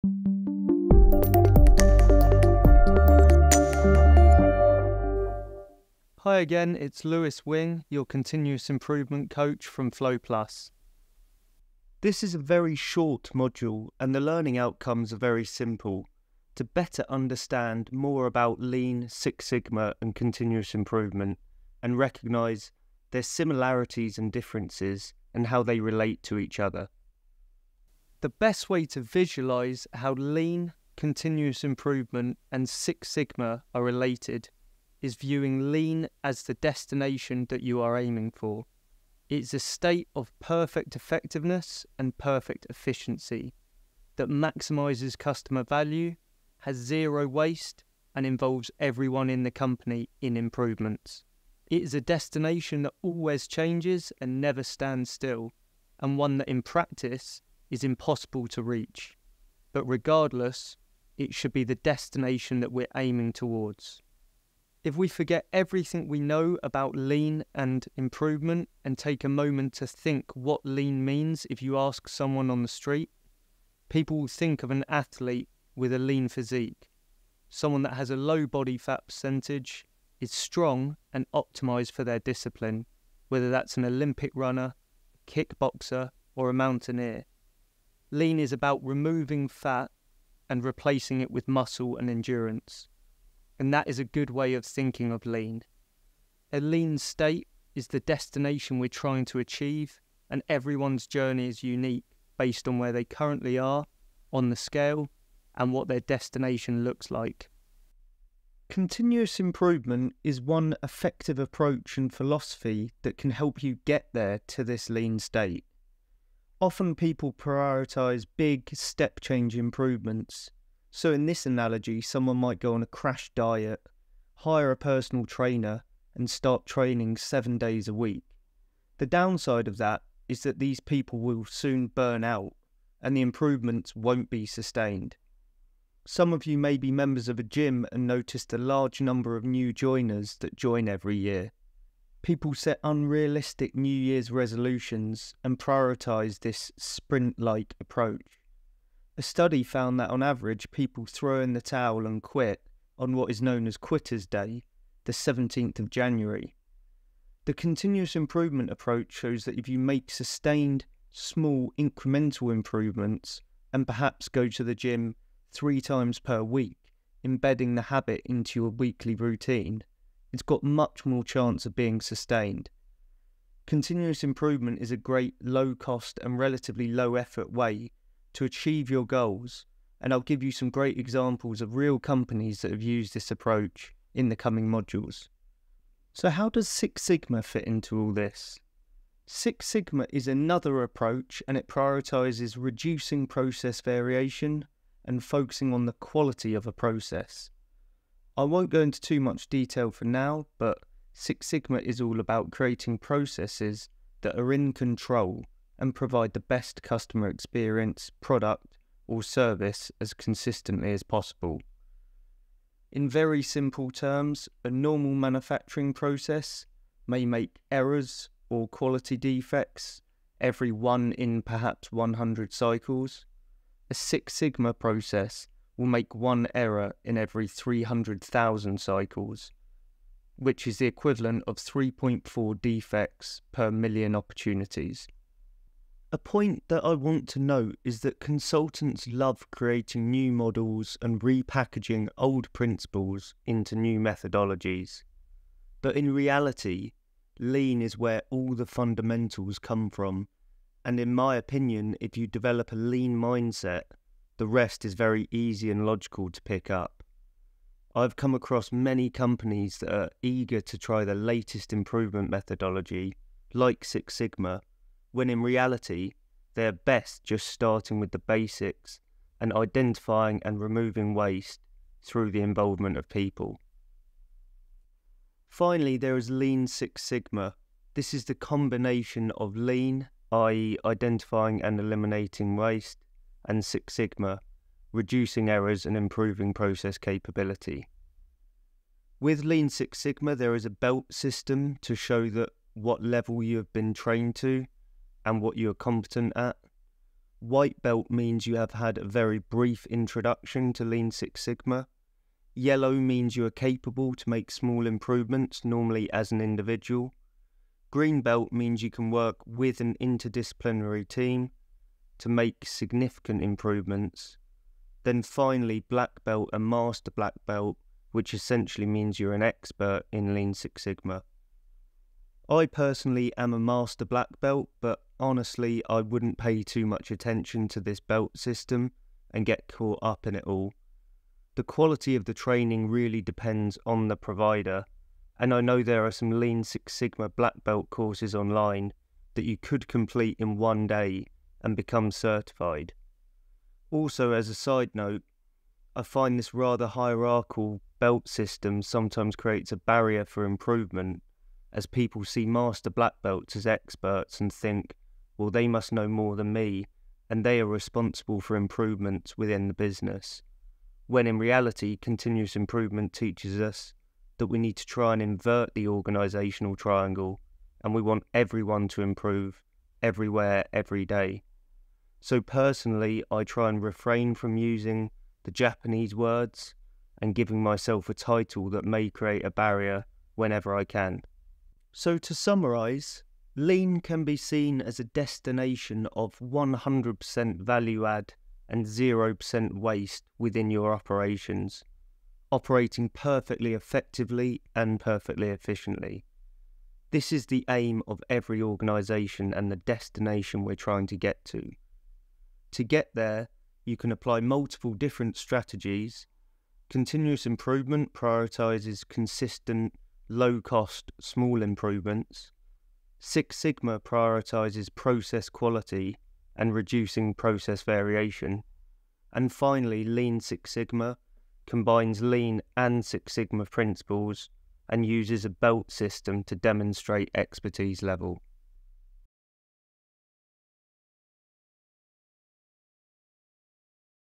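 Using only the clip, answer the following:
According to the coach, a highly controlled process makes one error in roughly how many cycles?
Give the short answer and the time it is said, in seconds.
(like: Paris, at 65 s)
300,000, at 227 s.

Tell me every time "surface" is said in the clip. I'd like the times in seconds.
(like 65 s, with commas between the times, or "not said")
not said.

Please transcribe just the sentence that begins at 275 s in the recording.
Finally, there is Lean Six Sigma.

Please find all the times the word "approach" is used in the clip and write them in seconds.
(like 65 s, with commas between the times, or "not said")
111 s, 147 s, 158 s, 183 s, 190 s.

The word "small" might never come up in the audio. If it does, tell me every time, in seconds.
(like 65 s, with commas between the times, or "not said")
161 s, 304 s, 411 s.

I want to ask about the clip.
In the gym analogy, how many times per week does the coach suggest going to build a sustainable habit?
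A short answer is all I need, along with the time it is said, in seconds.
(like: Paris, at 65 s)
3, at 165 s.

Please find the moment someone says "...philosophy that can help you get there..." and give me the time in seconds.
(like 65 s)
112 s.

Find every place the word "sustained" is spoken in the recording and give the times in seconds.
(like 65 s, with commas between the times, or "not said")
134 s, 160 s, 172 s.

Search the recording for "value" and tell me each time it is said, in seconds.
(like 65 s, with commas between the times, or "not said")
45 s, 387 s.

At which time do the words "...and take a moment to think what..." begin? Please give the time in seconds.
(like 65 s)
68 s.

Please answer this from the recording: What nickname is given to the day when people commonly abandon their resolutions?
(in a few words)
Quitter's Day.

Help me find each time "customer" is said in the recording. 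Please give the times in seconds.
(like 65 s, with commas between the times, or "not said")
45 s, 206 s.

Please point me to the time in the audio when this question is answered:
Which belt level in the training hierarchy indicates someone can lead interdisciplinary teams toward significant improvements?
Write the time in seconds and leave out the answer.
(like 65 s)
307 s.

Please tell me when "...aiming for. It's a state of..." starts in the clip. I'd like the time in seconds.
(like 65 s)
37 s.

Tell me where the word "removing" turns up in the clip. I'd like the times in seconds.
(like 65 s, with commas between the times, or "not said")
88 s, 270 s.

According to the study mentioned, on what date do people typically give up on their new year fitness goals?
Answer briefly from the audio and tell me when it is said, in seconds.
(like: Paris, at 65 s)
17th of January, at 155 s.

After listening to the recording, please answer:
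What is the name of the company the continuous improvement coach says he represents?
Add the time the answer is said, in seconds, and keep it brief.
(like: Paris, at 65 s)
FlowPlus, at 9 s.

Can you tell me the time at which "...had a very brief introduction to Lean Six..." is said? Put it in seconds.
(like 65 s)
298 s.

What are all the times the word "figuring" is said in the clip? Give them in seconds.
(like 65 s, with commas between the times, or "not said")
not said.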